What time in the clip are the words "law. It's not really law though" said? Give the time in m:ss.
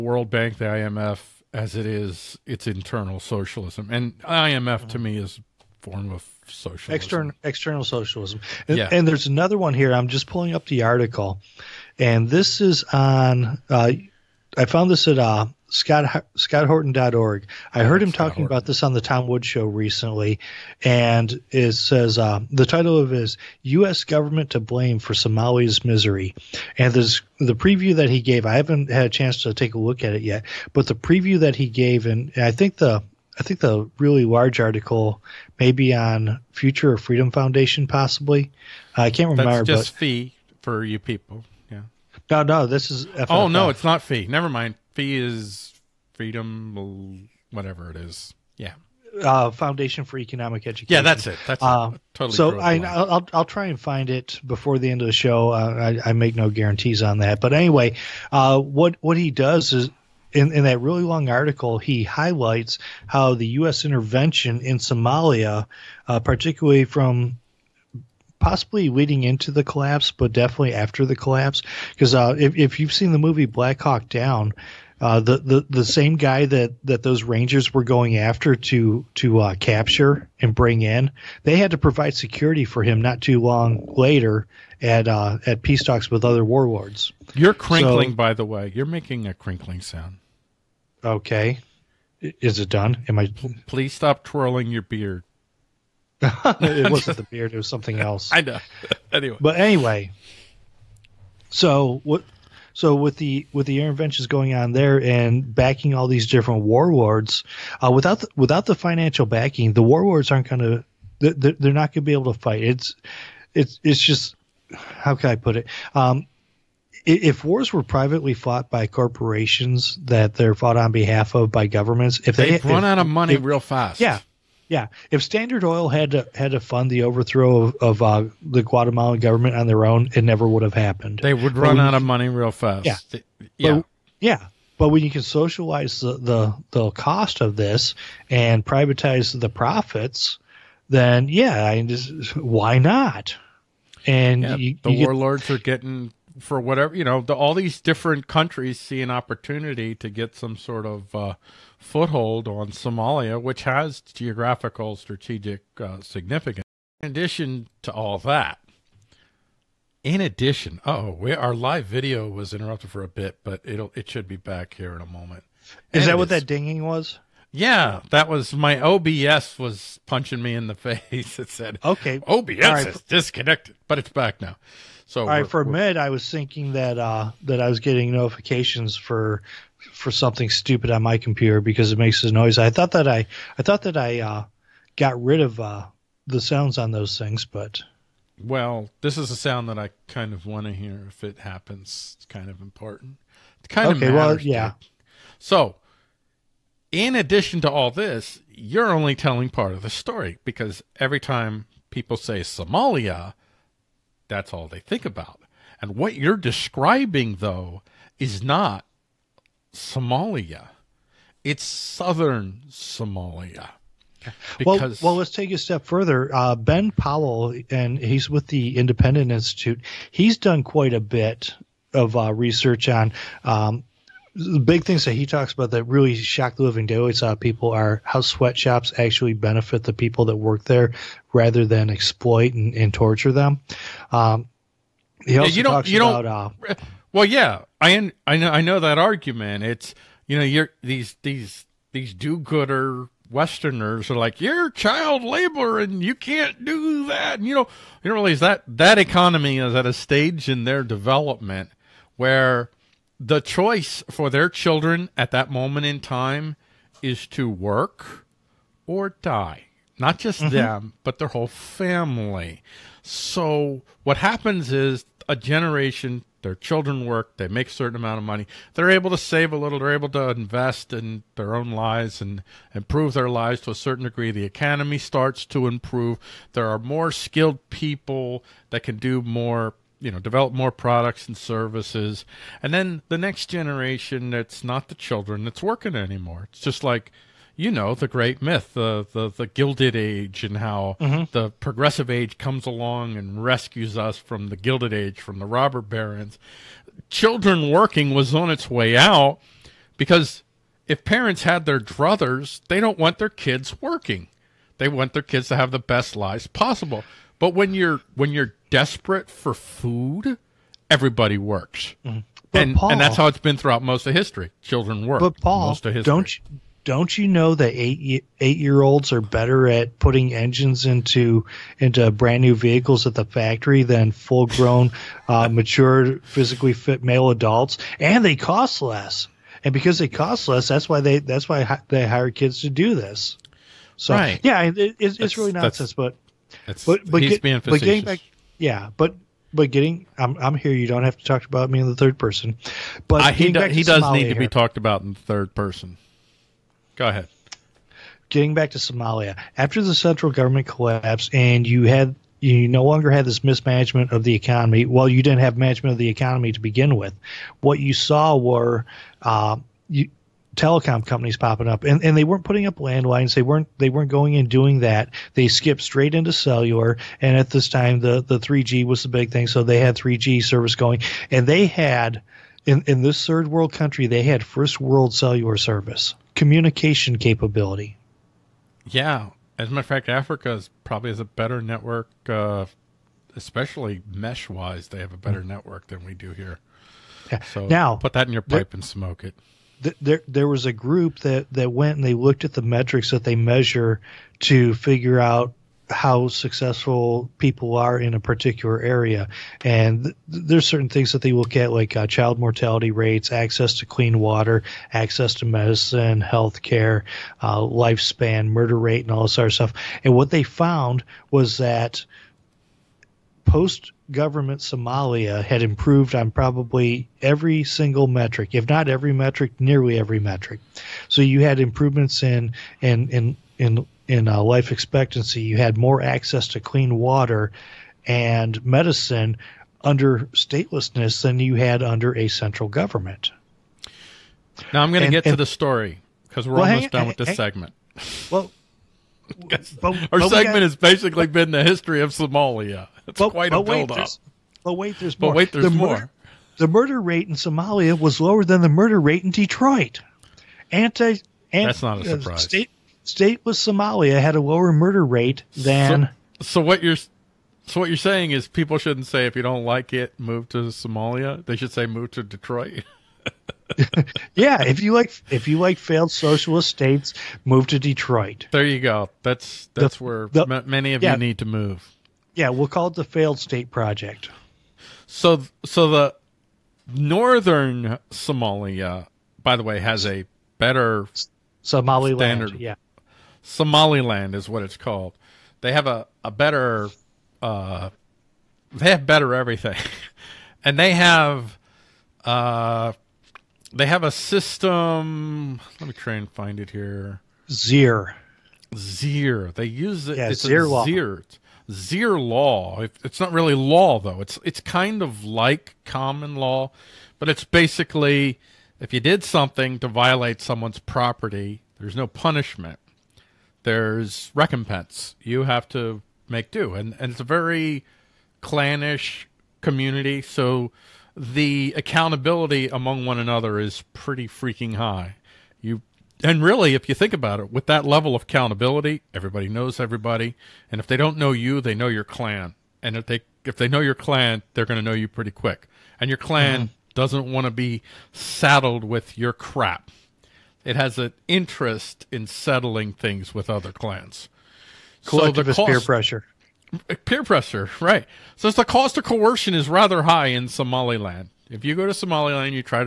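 8:22.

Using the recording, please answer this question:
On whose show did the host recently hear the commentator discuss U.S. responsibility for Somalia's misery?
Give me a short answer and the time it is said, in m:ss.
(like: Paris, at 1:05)
Tom Woods, at 0:18.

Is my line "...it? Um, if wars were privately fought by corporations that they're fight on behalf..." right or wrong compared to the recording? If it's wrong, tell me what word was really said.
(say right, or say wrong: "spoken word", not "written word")
wrong: "fought", not "fight".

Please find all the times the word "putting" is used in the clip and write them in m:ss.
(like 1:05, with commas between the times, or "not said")
5:19, 6:02.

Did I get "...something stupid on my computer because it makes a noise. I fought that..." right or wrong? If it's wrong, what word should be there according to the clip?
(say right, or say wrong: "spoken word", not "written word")
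wrong: "thought", not "fought".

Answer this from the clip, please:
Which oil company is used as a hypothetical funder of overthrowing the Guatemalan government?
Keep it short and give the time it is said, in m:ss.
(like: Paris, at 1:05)
Standard Oil, at 2:05.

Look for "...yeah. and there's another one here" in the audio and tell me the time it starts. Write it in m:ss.
0:08.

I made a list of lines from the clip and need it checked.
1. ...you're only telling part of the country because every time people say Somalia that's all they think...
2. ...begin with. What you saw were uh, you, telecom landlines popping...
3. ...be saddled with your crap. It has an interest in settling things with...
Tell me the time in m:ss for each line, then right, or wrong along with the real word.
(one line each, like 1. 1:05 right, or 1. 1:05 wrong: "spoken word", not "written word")
1. 3:18 wrong: "story", not "country"
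2. 5:56 wrong: "companies", not "landlines"
3. 8:57 right.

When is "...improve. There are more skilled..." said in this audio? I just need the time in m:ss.
4:35.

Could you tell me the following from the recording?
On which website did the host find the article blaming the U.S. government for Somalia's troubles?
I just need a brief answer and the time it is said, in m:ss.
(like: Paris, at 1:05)
scotthorton.org, at 0:16.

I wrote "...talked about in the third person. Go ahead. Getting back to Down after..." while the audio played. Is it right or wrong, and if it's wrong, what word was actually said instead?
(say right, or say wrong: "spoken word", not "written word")
wrong: "Somalia", not "Down".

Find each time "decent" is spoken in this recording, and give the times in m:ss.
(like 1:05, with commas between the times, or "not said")
not said.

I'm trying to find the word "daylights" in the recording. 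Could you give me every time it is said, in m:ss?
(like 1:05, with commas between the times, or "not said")
3:46.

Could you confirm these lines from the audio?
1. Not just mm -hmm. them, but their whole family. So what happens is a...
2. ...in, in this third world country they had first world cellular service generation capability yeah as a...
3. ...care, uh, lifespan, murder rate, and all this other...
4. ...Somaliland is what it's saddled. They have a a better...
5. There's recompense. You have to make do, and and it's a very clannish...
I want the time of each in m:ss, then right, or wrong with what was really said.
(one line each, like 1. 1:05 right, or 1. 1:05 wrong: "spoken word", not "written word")
1. 4:19 right
2. 6:12 wrong: "communication", not "generation"
3. 6:46 right
4. 8:03 wrong: "called", not "saddled"
5. 8:33 right.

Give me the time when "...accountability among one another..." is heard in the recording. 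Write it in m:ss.
8:41.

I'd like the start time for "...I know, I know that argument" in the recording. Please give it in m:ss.
3:58.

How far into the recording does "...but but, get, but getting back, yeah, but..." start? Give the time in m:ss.
5:36.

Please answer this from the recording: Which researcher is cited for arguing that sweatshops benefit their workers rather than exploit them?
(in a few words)
Ben Powell.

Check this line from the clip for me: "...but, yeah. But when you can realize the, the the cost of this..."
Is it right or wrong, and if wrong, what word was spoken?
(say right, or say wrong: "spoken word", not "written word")
wrong: "socialize", not "realize".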